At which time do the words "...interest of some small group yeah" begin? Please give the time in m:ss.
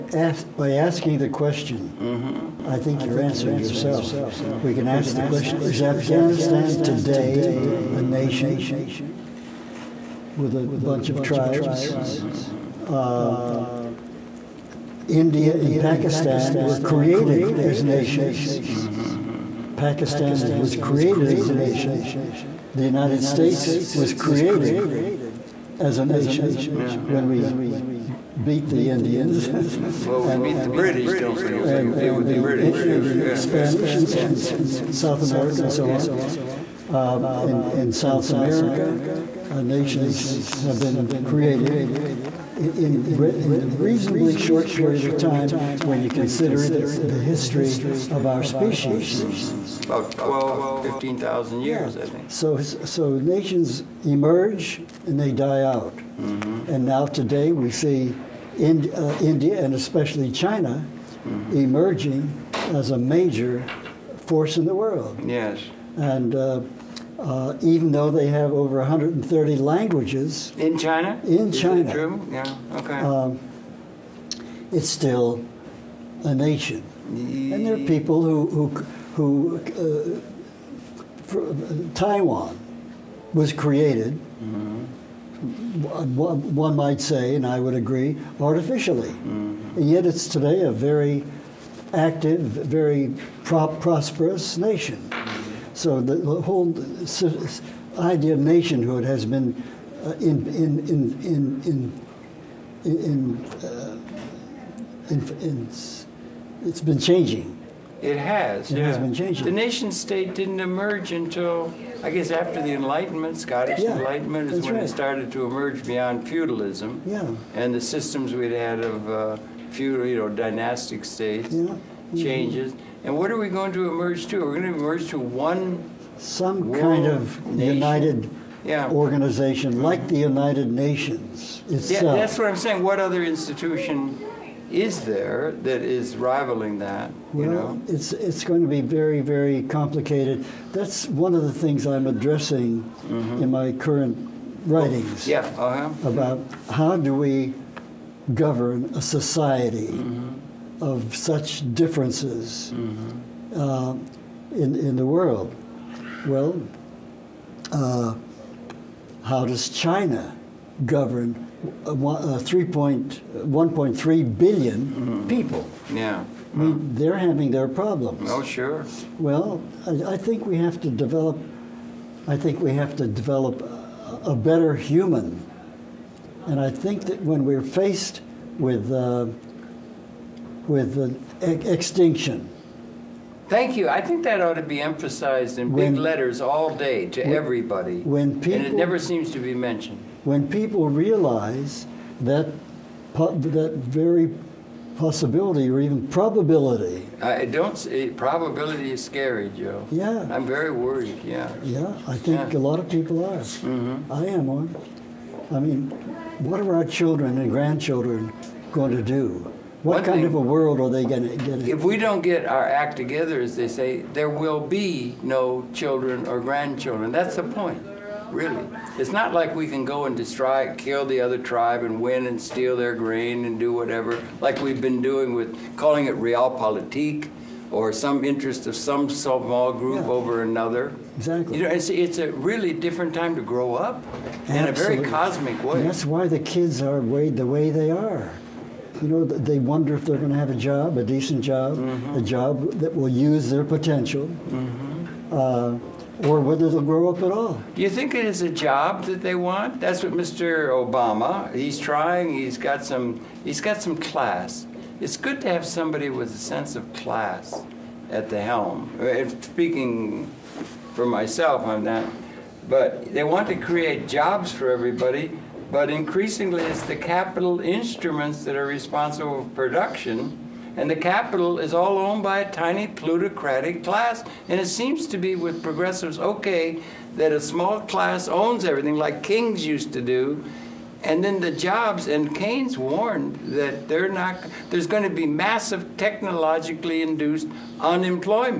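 3:48.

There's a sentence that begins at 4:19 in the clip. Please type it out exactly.
Uh, if speaking for myself, I'm not.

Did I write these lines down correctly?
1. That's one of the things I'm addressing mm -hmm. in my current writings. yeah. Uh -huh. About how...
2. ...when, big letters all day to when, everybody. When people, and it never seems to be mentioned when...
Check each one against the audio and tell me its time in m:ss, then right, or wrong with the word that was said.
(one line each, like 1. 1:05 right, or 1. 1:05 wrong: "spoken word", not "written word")
1. 2:20 right
2. 3:05 right.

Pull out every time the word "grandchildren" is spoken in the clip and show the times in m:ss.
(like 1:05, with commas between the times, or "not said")
3:27, 3:36.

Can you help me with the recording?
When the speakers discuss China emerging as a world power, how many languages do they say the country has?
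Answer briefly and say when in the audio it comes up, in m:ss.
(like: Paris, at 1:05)
over 130, at 1:08.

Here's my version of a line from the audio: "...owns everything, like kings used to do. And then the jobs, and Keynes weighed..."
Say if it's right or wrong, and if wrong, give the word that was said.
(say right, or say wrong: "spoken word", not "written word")
wrong: "warned", not "weighed".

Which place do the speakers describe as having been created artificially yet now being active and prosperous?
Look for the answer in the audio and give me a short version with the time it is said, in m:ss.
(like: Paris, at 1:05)
Taiwan, at 1:21.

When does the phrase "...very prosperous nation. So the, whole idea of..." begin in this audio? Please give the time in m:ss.
1:32.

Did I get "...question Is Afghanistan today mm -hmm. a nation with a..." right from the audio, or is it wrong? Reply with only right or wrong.
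right.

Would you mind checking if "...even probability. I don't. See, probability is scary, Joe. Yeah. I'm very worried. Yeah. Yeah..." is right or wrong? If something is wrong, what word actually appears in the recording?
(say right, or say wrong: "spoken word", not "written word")
right.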